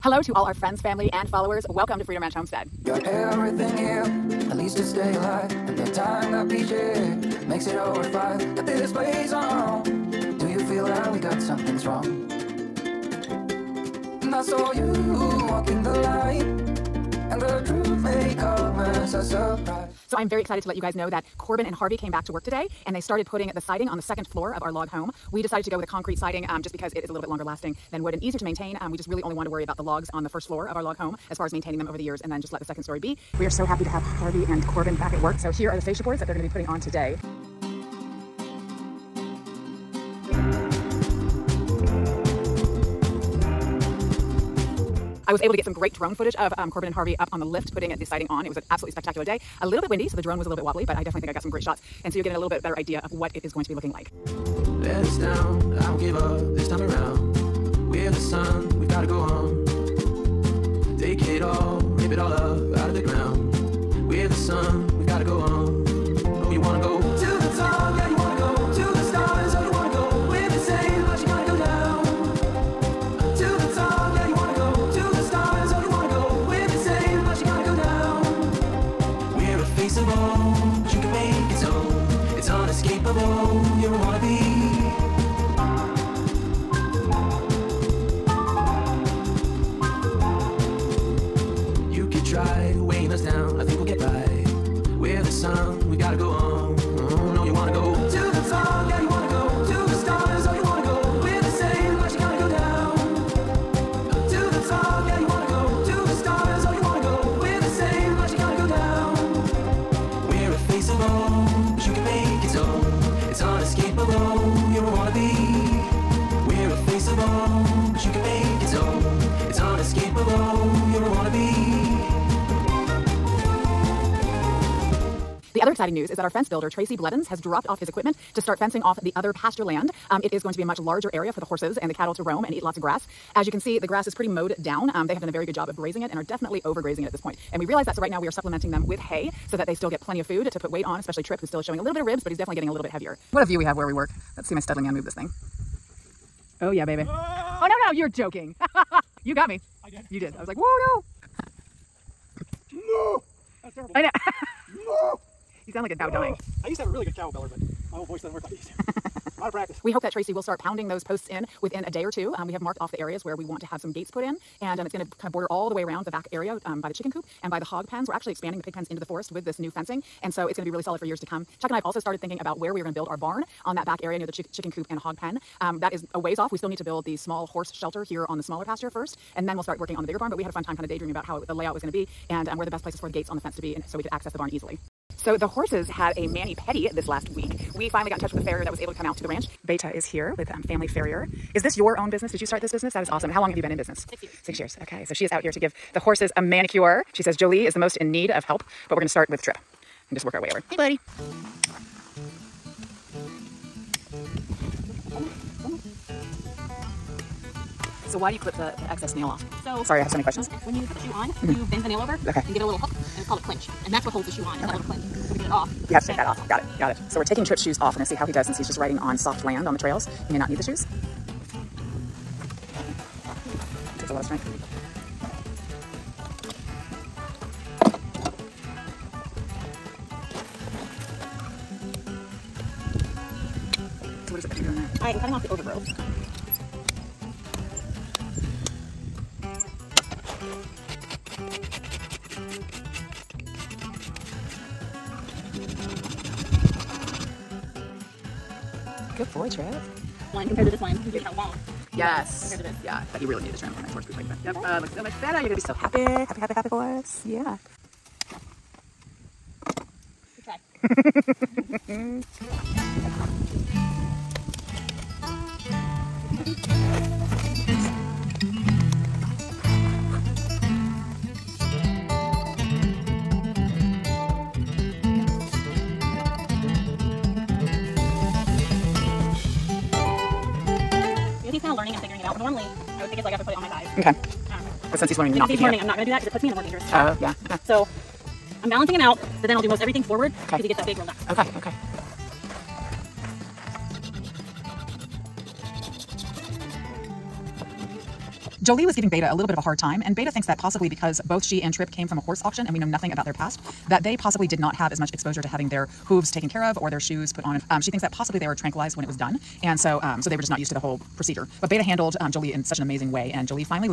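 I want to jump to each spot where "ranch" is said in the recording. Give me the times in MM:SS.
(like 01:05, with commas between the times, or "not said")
00:02, 03:09.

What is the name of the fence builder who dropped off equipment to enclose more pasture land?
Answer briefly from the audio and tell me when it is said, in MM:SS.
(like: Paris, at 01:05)
Tracy Blevins, at 02:06.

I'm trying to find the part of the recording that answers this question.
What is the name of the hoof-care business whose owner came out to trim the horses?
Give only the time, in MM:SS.
03:10.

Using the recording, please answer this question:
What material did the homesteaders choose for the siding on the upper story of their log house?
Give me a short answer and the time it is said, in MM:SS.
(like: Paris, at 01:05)
Concrete, at 00:25.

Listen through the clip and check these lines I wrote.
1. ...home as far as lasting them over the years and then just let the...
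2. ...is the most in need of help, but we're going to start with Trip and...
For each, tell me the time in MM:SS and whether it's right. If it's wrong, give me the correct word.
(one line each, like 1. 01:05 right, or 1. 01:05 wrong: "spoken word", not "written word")
1. 00:30 wrong: "maintaining", not "lasting"
2. 03:17 right.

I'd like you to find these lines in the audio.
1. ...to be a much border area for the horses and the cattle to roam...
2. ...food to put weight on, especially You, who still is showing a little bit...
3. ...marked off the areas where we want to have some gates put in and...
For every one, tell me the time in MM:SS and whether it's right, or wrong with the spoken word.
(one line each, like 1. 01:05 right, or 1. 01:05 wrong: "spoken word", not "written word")
1. 02:10 wrong: "larger", not "border"
2. 02:20 wrong: "Trip", not "You"
3. 02:42 right.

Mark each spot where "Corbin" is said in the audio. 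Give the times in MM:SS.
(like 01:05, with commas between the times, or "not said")
00:21, 00:34, 00:46.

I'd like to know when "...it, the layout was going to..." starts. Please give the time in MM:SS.
03:01.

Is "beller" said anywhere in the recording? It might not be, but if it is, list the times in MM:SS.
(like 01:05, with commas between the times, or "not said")
02:37.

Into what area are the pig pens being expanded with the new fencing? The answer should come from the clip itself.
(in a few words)
The forest.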